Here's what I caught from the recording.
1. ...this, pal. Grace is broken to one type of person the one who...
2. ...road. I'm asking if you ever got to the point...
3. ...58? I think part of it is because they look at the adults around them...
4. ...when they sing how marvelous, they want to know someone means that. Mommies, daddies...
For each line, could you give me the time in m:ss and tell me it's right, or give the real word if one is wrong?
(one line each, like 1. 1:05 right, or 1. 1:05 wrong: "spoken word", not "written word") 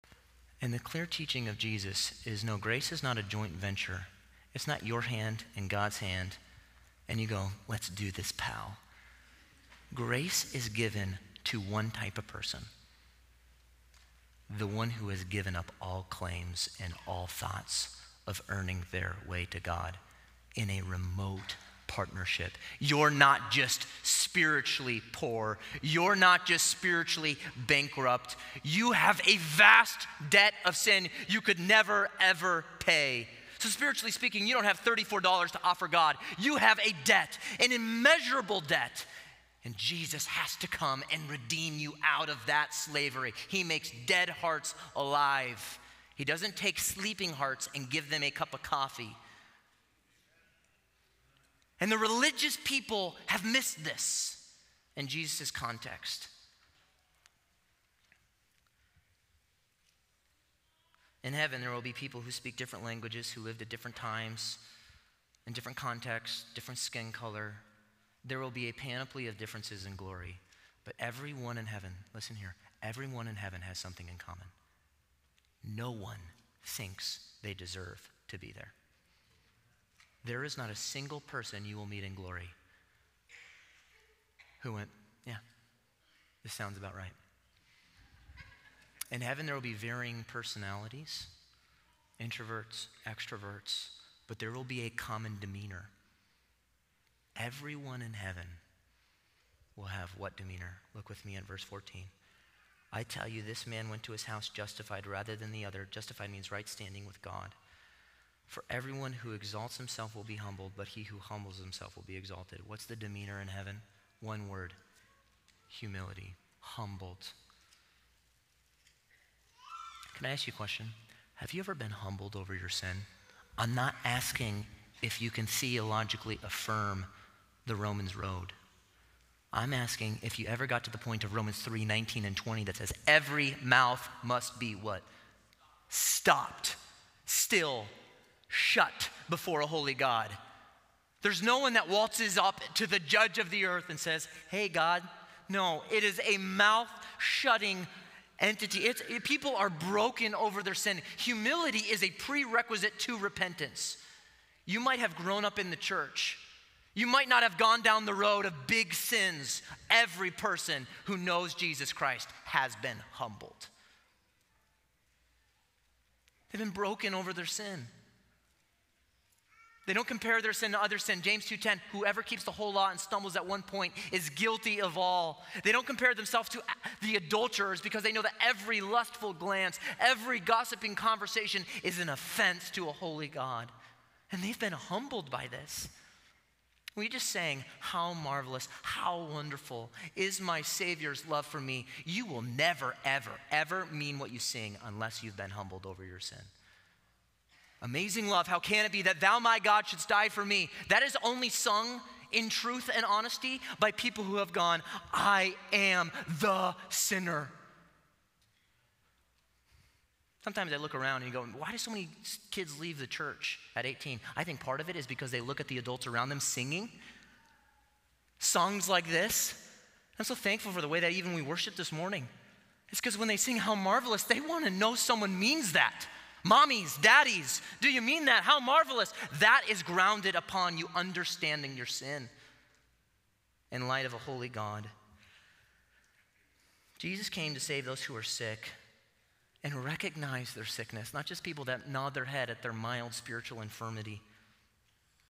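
1. 0:08 wrong: "given", not "broken"
2. 2:08 right
3. 3:33 wrong: "18", not "58"
4. 3:43 right.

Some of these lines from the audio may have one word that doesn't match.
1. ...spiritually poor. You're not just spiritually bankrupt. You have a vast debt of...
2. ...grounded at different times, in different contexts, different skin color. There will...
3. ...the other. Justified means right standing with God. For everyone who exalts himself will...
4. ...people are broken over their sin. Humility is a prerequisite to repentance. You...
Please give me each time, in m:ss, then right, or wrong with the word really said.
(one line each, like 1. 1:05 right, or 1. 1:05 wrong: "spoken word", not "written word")
1. 0:24 right
2. 1:03 wrong: "lived", not "grounded"
3. 1:45 right
4. 2:29 right.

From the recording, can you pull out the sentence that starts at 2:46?
They've been broken over their sin.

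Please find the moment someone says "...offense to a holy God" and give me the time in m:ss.
3:02.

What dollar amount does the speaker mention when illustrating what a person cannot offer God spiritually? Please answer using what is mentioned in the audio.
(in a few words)
$34.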